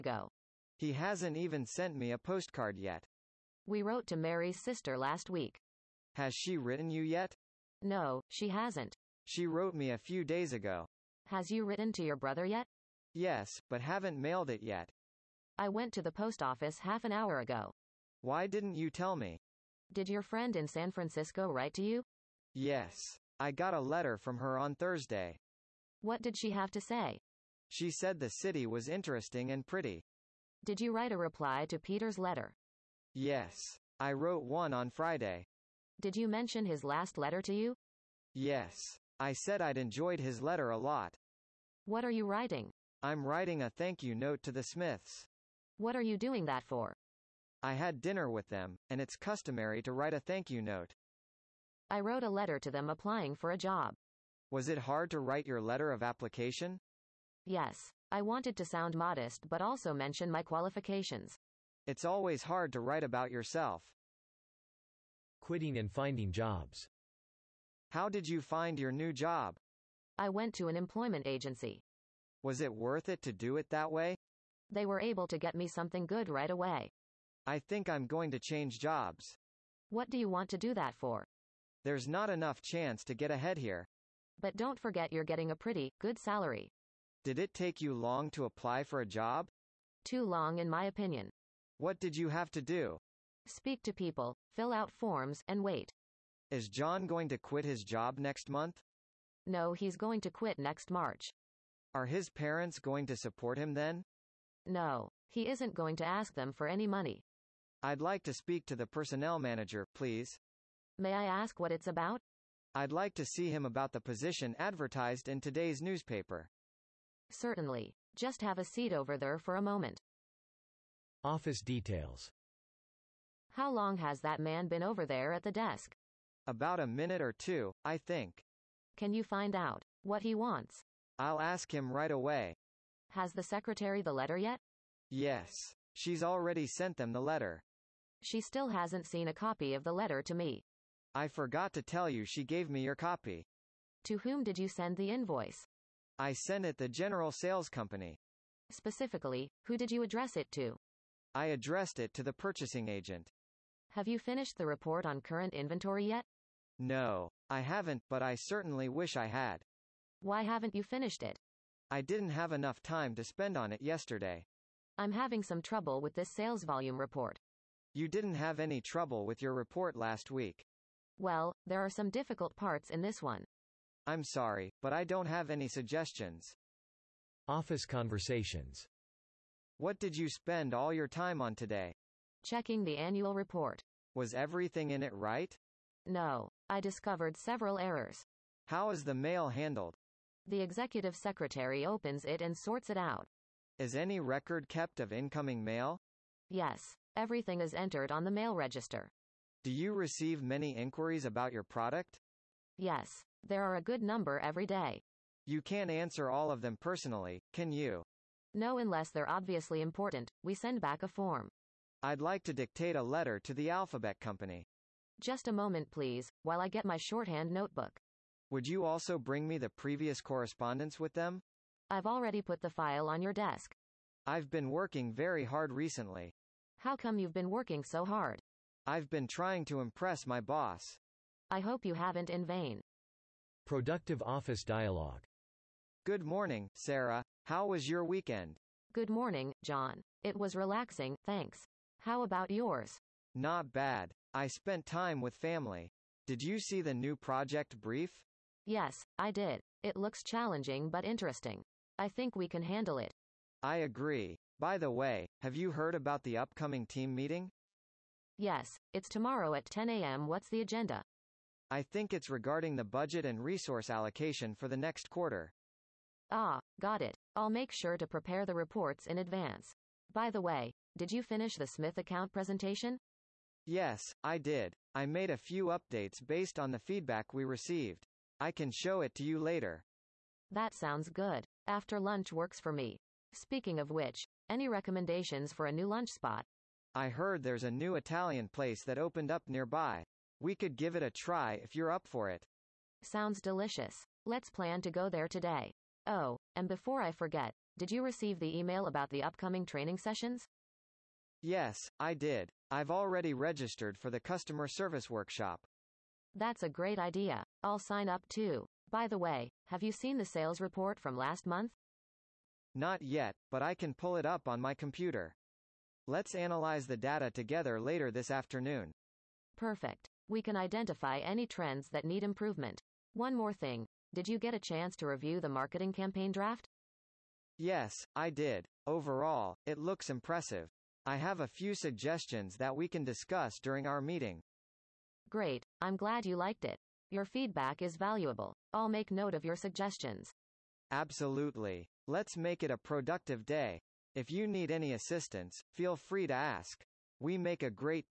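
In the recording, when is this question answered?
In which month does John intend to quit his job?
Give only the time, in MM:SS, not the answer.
01:40.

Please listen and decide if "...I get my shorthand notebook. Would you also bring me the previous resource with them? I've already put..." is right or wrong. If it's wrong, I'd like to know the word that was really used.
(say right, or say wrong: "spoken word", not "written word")
wrong: "correspondence", not "resource".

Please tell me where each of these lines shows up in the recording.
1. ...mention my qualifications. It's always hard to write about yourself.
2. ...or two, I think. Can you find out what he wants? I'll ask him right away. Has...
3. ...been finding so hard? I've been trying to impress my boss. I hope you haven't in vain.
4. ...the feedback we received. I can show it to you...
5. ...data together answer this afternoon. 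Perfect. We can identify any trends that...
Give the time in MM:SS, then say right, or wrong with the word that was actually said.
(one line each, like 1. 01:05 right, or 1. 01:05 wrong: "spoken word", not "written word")
1. 00:59 right
2. 02:07 right
3. 03:47 wrong: "working", not "finding"
4. 04:36 right
5. 05:16 wrong: "later", not "answer".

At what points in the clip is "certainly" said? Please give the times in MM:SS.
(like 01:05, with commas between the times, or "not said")
01:57, 02:38.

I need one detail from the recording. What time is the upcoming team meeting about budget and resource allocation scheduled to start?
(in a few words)
10 a.m.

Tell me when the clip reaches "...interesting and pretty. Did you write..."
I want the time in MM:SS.
00:28.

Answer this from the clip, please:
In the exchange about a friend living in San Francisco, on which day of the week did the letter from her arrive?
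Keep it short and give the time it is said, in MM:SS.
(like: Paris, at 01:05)
Thursday, at 00:24.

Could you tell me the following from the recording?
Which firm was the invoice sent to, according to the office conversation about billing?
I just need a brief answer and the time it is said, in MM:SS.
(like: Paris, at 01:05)
General Sales Company, at 02:26.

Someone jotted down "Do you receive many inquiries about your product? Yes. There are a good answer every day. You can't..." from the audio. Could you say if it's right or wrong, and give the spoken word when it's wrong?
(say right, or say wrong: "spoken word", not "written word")
wrong: "number", not "answer".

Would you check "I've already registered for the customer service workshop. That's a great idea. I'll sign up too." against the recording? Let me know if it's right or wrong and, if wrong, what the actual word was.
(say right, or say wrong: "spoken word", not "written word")
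right.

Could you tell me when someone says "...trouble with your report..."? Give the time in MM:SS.
02:48.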